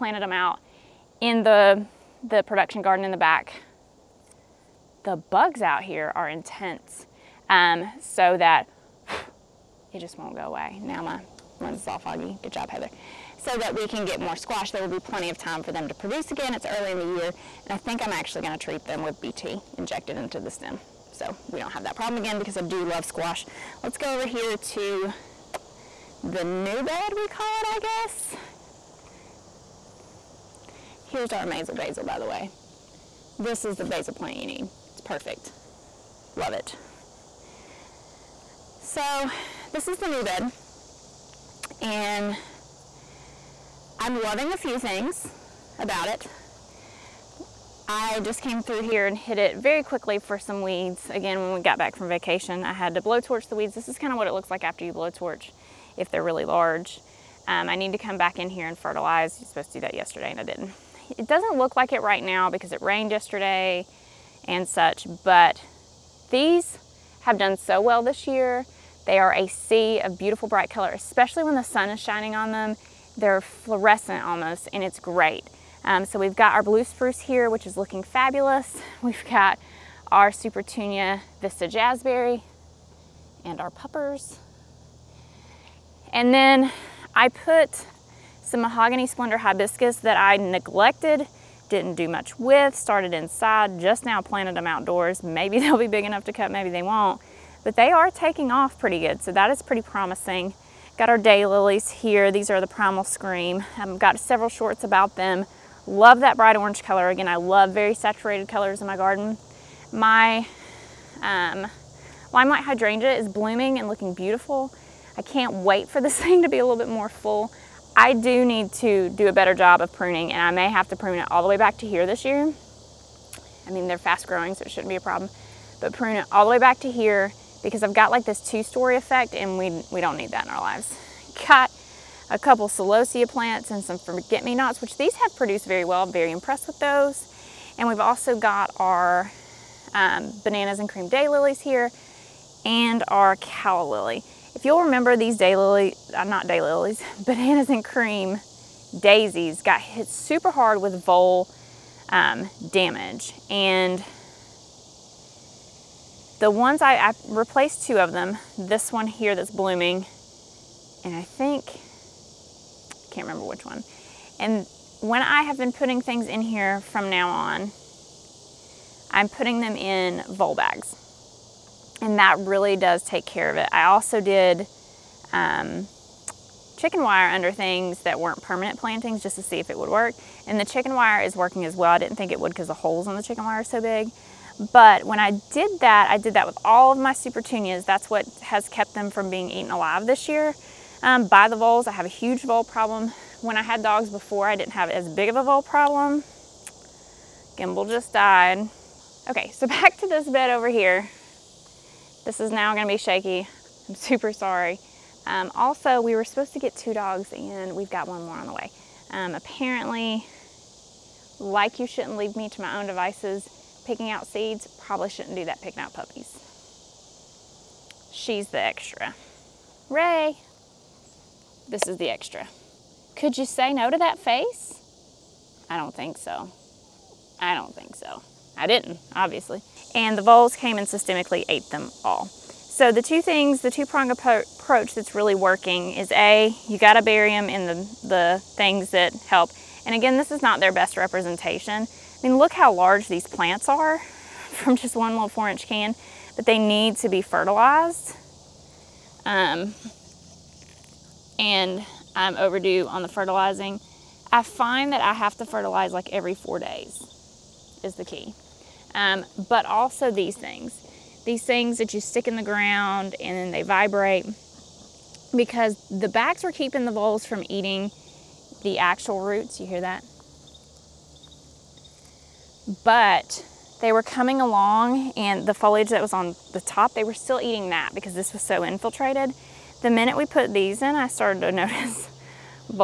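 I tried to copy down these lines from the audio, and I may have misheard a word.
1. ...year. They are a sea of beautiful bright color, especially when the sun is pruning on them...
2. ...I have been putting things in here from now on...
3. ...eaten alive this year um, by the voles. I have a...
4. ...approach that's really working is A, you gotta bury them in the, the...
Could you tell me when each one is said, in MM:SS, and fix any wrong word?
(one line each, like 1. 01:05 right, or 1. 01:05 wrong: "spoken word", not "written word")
1. 01:08 wrong: "shining", not "pruning"
2. 02:45 right
3. 03:09 right
4. 03:54 right.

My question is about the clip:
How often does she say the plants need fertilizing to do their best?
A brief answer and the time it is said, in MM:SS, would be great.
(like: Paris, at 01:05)
Every 4 days, at 04:16.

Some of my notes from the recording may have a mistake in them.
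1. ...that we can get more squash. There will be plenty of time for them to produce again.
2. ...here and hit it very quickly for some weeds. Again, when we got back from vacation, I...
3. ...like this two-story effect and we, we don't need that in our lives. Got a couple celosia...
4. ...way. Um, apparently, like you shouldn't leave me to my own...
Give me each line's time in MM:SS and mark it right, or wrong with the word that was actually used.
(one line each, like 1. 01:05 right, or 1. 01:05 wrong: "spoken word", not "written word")
1. 00:13 right
2. 00:48 right
3. 02:08 right
4. 03:28 right.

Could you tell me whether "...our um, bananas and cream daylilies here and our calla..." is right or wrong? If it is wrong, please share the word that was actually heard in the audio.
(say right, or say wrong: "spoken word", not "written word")
right.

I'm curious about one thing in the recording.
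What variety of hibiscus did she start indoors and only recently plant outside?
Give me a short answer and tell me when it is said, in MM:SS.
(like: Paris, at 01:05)
Mahogany Splendor, at 01:28.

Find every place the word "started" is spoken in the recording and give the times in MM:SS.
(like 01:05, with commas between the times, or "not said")
01:32, 04:41.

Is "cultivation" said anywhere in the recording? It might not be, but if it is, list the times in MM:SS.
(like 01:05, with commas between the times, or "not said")
not said.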